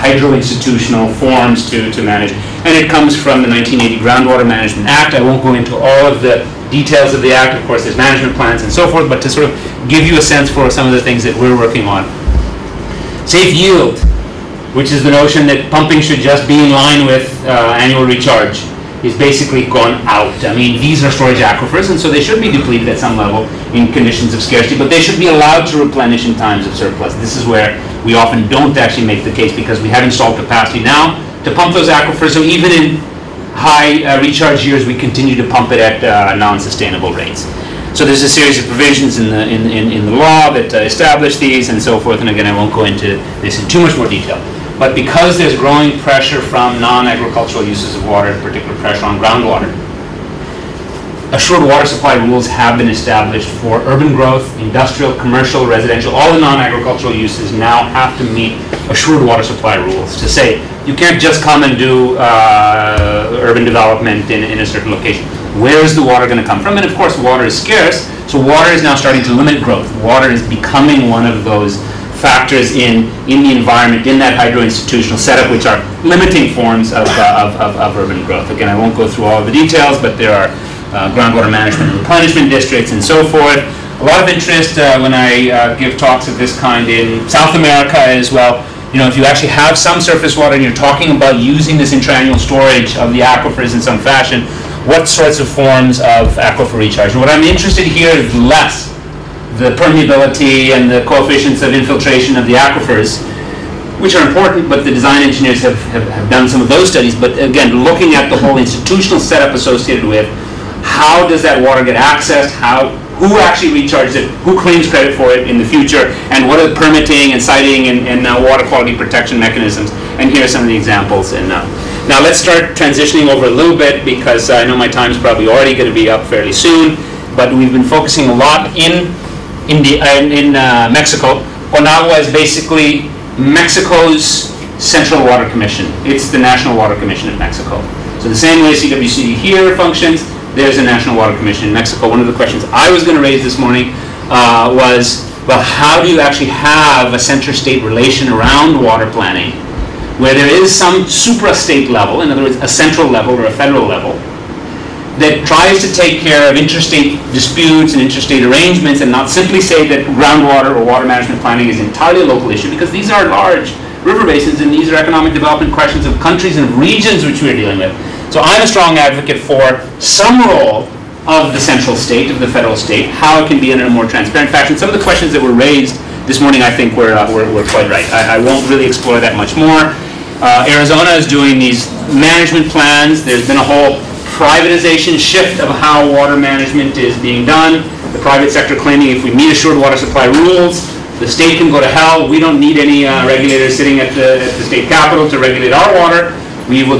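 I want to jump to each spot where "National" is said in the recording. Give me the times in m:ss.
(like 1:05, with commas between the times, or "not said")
2:16, 2:20.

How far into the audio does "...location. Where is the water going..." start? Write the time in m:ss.
1:04.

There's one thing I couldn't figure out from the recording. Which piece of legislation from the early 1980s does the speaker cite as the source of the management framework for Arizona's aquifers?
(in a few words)
1980 Groundwater Management Act.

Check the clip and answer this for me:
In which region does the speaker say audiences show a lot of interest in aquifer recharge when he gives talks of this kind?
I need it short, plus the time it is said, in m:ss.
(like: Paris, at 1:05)
South America, at 1:27.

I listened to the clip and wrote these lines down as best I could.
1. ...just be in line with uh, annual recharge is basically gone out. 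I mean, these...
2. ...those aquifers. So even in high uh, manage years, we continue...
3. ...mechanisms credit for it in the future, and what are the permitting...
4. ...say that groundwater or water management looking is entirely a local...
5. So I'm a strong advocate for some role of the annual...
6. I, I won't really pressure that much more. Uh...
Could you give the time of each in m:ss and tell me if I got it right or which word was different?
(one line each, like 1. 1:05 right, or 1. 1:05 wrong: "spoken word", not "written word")
1. 0:16 right
2. 0:31 wrong: "recharge", not "manage"
3. 1:54 wrong: "claims", not "mechanisms"
4. 2:39 wrong: "planning", not "looking"
5. 2:48 wrong: "central", not "annual"
6. 2:58 wrong: "explore", not "pressure".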